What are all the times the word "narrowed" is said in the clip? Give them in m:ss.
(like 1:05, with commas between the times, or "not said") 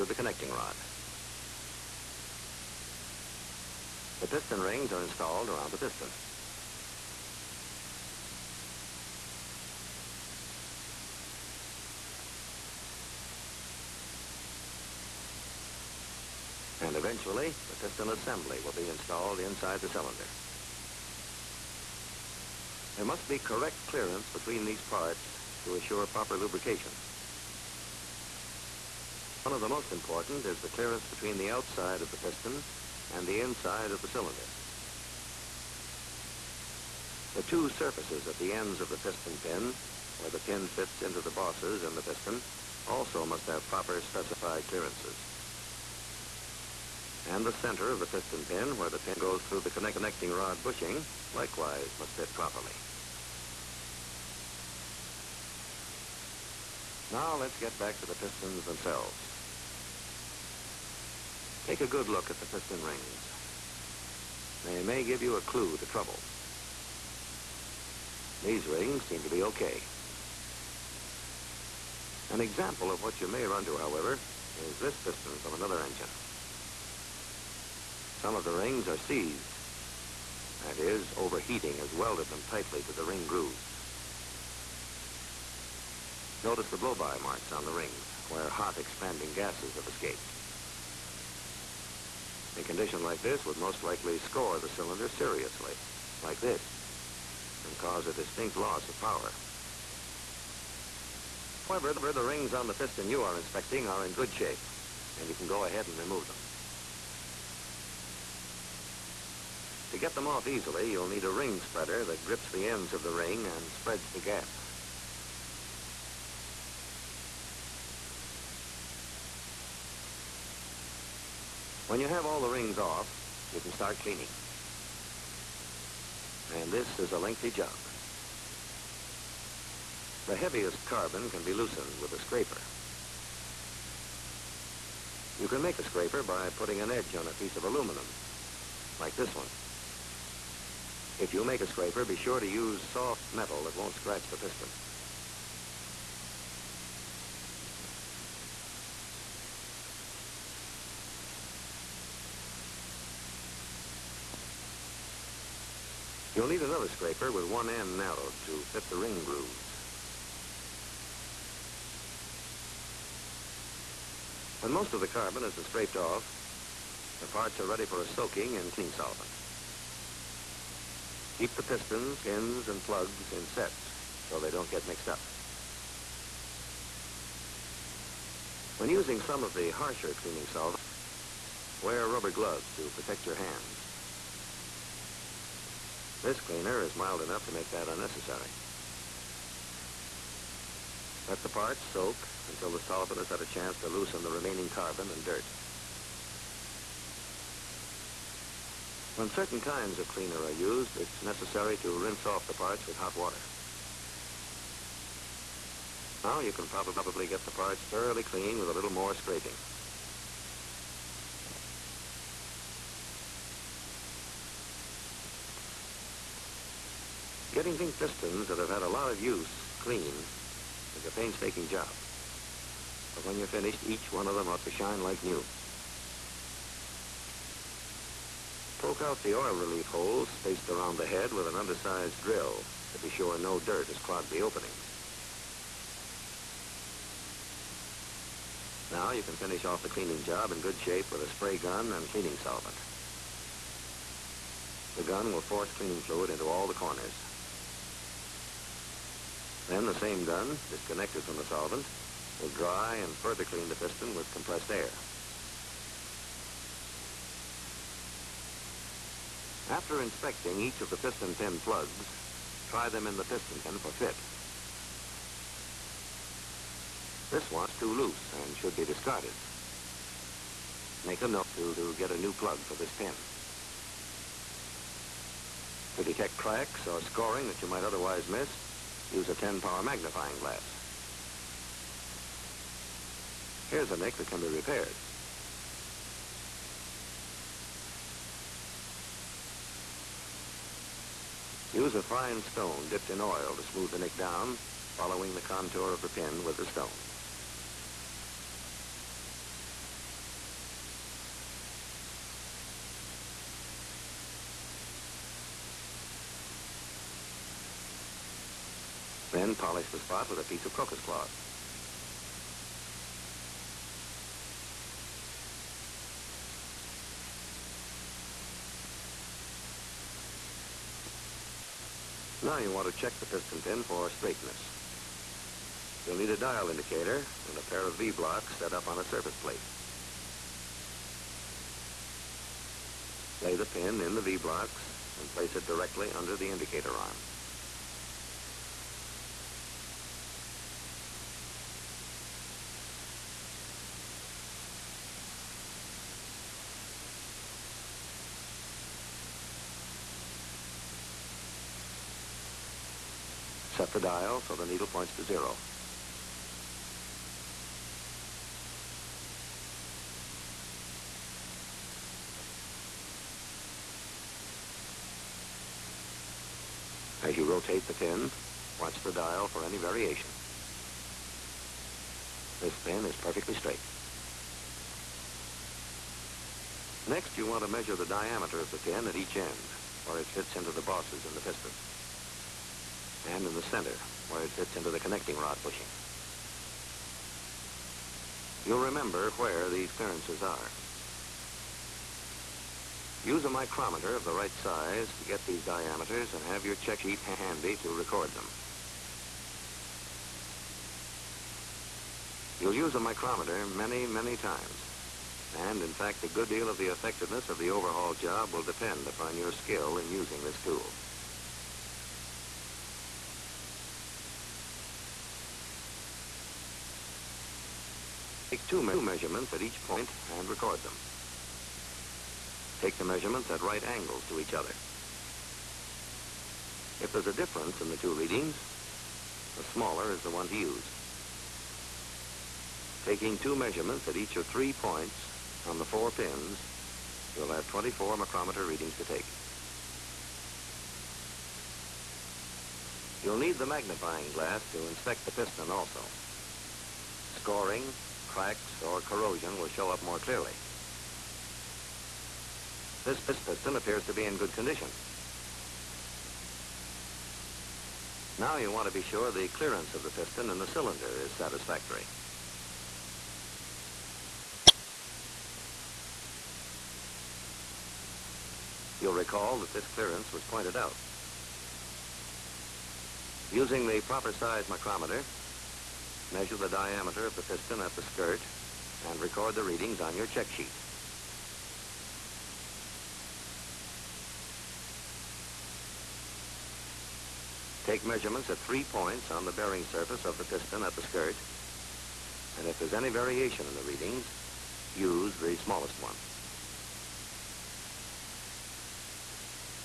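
2:37.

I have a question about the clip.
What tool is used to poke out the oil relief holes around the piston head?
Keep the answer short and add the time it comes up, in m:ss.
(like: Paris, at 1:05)
Undersized drill, at 3:51.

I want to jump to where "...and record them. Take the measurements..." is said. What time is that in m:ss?
7:00.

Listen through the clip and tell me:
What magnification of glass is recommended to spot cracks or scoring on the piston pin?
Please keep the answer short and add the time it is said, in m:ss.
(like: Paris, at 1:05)
10-power, at 4:39.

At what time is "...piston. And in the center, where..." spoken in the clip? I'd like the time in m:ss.
6:21.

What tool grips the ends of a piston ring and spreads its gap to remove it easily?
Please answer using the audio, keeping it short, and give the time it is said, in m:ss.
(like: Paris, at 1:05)
Ring spreader, at 1:51.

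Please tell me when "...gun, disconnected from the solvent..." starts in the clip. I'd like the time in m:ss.
4:10.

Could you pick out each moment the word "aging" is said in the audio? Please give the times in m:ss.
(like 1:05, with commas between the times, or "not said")
not said.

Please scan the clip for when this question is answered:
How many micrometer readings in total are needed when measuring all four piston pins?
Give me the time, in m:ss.
7:17.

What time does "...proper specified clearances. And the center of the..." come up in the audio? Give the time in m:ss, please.
0:43.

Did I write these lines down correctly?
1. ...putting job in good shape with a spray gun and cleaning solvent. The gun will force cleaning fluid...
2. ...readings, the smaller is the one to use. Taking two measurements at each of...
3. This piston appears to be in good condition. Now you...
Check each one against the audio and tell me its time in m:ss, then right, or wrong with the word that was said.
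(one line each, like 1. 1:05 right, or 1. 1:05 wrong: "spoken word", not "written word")
1. 3:59 wrong: "cleaning", not "putting"
2. 7:08 right
3. 7:33 right.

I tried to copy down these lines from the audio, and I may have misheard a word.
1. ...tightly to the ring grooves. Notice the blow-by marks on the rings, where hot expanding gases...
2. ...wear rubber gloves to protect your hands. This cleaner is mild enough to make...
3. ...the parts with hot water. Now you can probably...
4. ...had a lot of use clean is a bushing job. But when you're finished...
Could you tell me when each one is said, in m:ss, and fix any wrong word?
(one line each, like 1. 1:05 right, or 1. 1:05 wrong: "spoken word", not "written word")
1. 1:22 right
2. 3:01 right
3. 3:22 right
4. 3:38 wrong: "painstaking", not "bushing".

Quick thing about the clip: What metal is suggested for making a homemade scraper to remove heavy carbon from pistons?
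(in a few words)
Aluminum.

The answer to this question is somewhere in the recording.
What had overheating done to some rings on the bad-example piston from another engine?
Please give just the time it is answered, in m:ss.
1:19.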